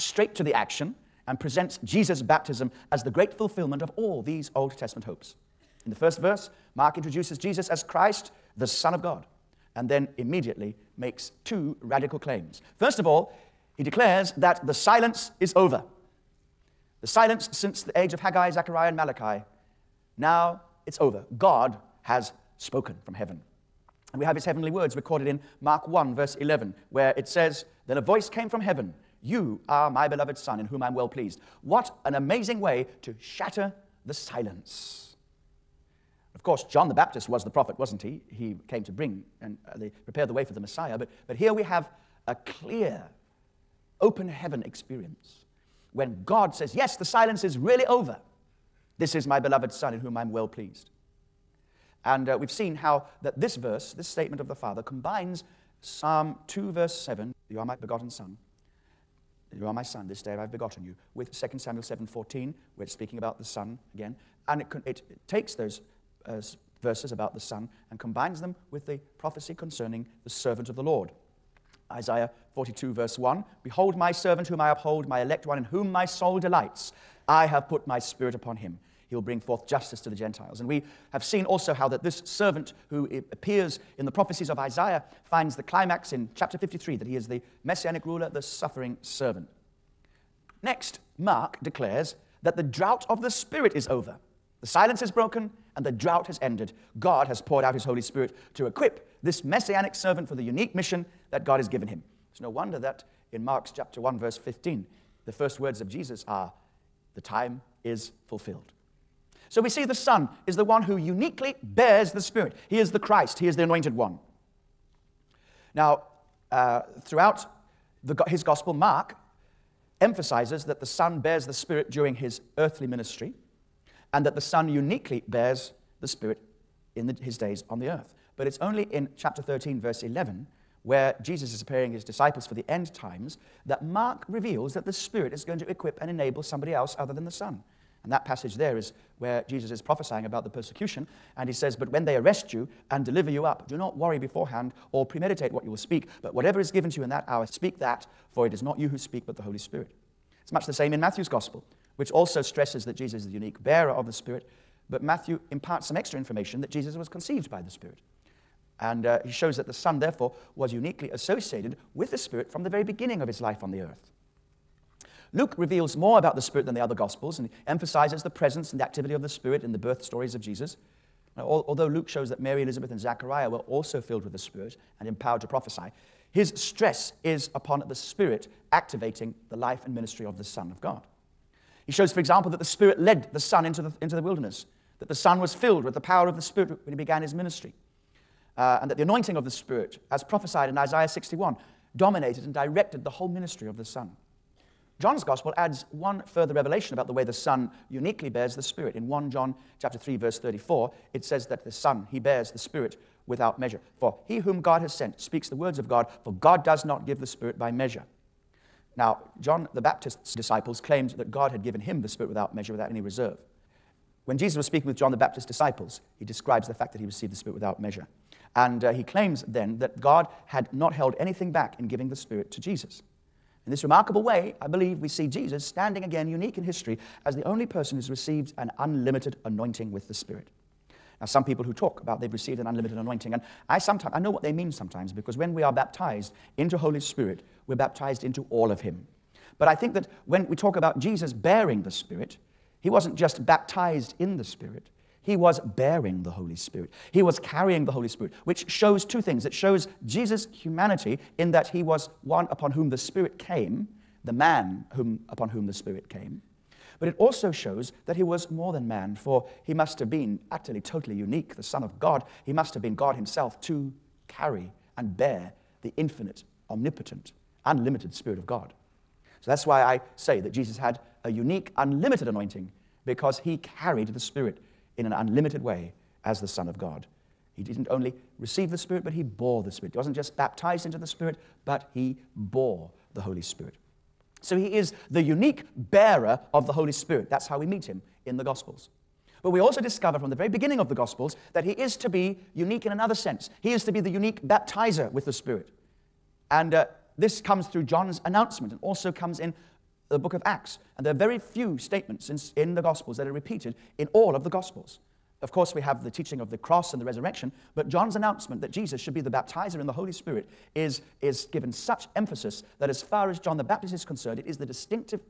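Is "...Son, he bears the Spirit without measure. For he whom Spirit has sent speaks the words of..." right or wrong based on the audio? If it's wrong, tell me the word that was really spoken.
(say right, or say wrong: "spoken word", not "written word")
wrong: "God", not "Spirit".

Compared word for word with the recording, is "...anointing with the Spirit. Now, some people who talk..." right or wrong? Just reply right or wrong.
right.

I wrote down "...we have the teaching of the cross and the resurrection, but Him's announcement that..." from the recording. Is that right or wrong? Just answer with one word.
wrong.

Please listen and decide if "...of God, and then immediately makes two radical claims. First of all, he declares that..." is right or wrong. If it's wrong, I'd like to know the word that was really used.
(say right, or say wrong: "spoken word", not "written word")
right.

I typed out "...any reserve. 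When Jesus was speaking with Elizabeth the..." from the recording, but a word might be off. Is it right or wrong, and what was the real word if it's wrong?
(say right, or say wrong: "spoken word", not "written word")
wrong: "John", not "Elizabeth".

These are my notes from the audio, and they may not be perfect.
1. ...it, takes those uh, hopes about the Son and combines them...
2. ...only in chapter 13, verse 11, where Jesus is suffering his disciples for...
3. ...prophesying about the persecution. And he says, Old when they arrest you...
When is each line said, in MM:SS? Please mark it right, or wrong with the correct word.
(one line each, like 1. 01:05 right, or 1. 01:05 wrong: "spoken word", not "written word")
1. 01:04 wrong: "verses", not "hopes"
2. 02:08 wrong: "preparing", not "suffering"
3. 02:19 wrong: "But", not "Old".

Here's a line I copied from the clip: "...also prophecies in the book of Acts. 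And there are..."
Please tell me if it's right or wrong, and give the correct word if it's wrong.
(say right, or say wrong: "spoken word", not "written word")
wrong: "comes", not "prophecies".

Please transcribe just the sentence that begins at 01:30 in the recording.
Next, Mark declares that the drought of the Spirit is over.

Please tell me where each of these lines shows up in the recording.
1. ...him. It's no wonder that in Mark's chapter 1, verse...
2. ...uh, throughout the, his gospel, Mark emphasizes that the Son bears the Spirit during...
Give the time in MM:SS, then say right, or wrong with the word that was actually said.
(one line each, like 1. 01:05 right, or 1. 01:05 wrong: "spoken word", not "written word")
1. 01:41 right
2. 01:56 right.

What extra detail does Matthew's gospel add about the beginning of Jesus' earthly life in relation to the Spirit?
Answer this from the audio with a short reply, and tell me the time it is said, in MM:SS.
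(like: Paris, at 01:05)
Conceived by the Spirit, at 02:37.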